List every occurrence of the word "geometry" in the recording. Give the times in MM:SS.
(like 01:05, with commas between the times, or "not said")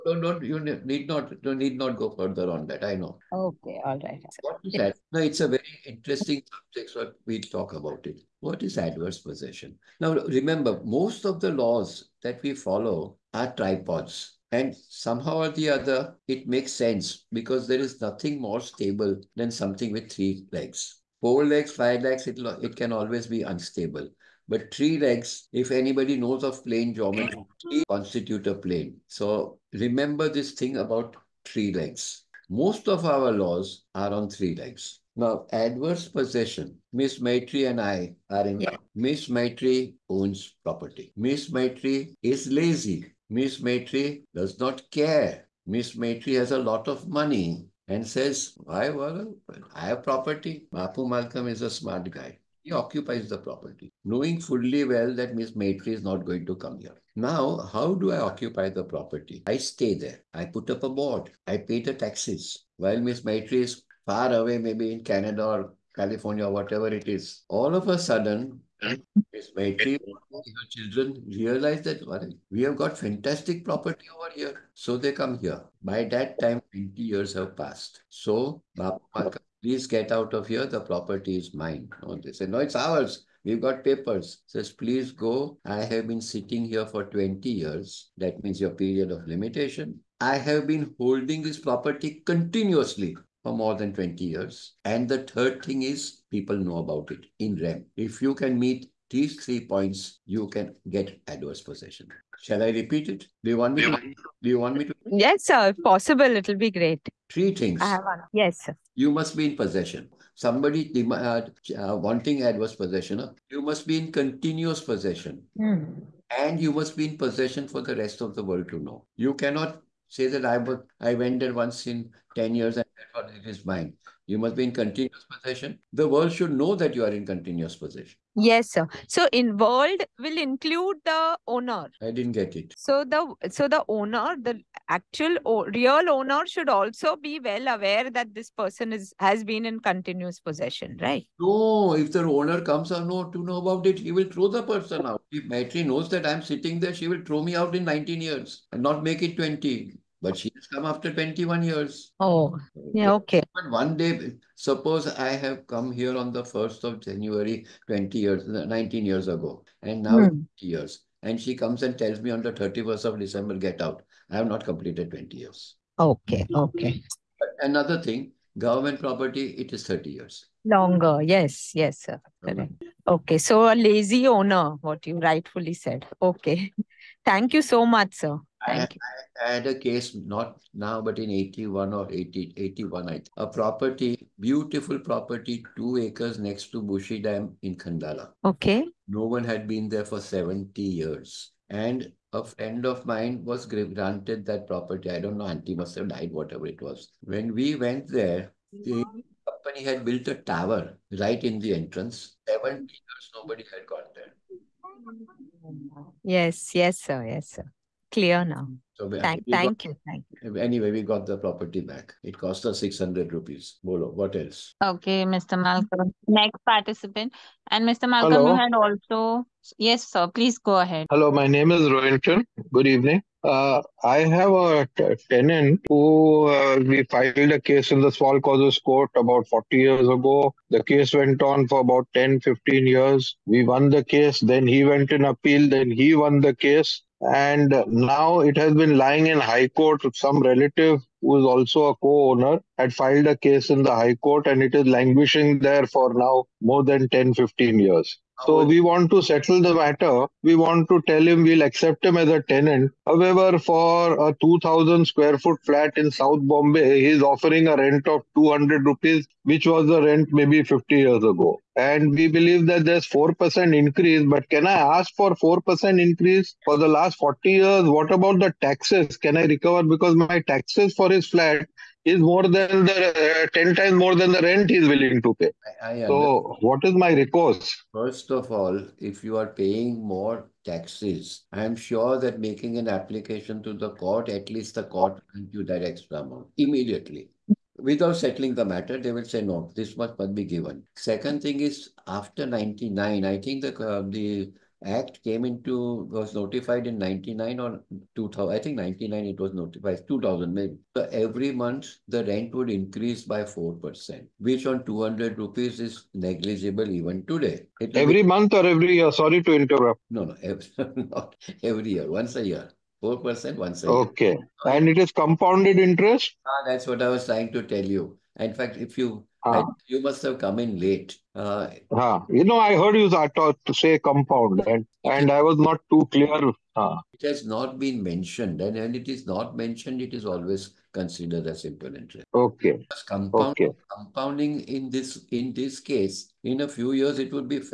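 00:26.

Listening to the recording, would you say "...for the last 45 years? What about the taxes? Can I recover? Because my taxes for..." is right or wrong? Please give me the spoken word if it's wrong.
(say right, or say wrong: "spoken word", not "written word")
wrong: "40", not "45".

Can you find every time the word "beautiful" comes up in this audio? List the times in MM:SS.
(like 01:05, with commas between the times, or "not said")
03:04.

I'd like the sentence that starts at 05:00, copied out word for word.
So every month the rent would increase by 4%, which on 200 rupees is negligible even today.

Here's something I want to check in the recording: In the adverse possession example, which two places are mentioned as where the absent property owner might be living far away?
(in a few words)
Canada or California.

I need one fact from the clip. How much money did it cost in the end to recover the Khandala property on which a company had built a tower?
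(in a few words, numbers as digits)
600 rupees.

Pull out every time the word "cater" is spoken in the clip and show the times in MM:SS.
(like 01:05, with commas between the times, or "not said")
not said.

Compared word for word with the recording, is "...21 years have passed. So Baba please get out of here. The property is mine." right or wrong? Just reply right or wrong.
wrong.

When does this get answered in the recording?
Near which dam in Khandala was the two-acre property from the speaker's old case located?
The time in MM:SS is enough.
03:06.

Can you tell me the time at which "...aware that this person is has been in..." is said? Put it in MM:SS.
02:17.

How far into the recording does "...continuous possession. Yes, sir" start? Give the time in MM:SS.
02:07.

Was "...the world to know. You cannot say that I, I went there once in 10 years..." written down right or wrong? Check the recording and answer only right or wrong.
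right.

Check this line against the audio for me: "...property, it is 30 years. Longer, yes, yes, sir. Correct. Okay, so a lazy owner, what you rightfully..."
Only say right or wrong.
right.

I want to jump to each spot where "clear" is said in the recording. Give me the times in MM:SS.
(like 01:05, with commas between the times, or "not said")
03:28, 05:26.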